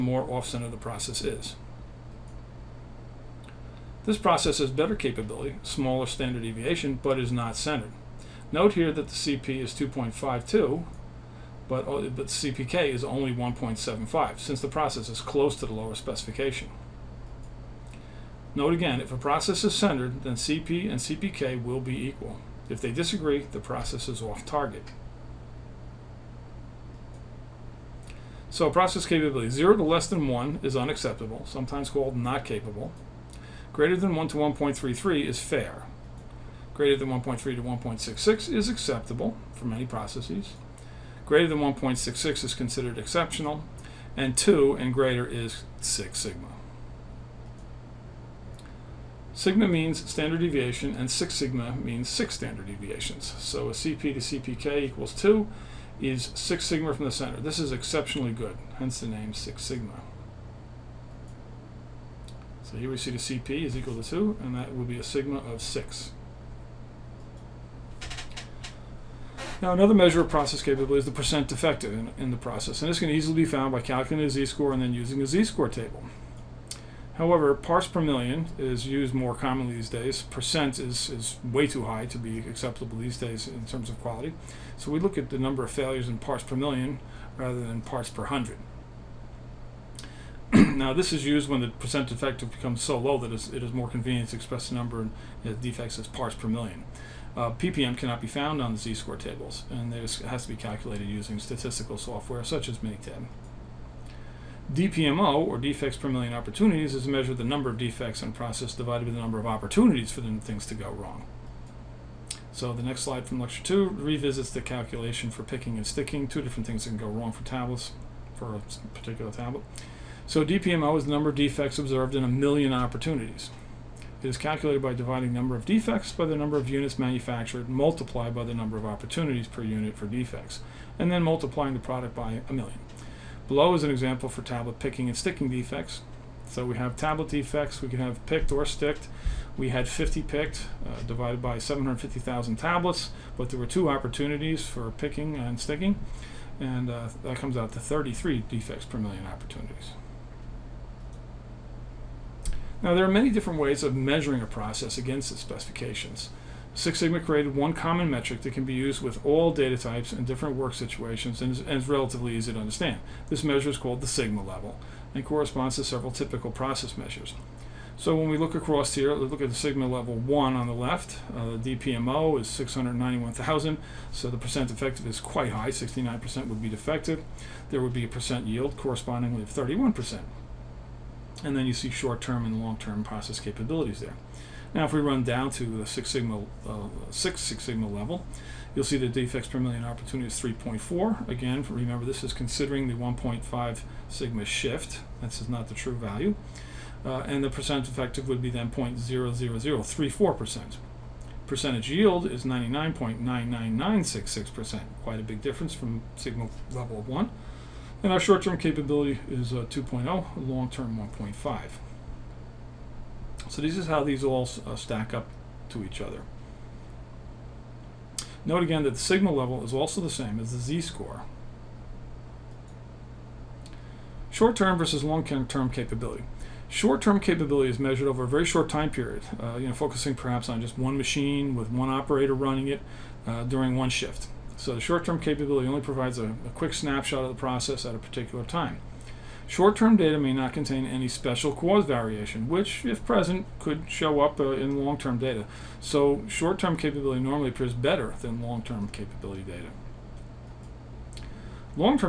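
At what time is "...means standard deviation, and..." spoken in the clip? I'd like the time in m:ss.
0:49.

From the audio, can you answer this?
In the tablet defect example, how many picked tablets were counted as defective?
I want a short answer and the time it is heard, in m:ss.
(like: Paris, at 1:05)
50, at 2:19.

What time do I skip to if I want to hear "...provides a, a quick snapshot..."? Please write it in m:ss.
3:55.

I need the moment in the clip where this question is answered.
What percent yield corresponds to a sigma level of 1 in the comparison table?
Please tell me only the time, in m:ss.
2:59.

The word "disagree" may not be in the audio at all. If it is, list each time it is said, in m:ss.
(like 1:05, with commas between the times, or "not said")
0:22.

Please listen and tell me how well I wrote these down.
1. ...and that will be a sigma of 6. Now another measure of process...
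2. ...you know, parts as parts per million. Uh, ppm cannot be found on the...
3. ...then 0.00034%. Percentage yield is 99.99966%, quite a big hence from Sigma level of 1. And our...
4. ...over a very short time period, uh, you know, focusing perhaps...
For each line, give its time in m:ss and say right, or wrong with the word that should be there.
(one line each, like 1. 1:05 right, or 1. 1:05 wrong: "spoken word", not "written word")
1. 1:04 right
2. 1:35 wrong: "defects", not "parts"
3. 3:18 wrong: "difference", not "hence"
4. 3:48 right.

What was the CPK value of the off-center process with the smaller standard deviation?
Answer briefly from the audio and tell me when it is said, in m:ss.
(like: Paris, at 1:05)
1.75, at 0:13.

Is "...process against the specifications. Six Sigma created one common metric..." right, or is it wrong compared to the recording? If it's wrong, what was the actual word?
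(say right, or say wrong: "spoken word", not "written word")
right.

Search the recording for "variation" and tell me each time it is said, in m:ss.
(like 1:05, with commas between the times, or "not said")
4:01.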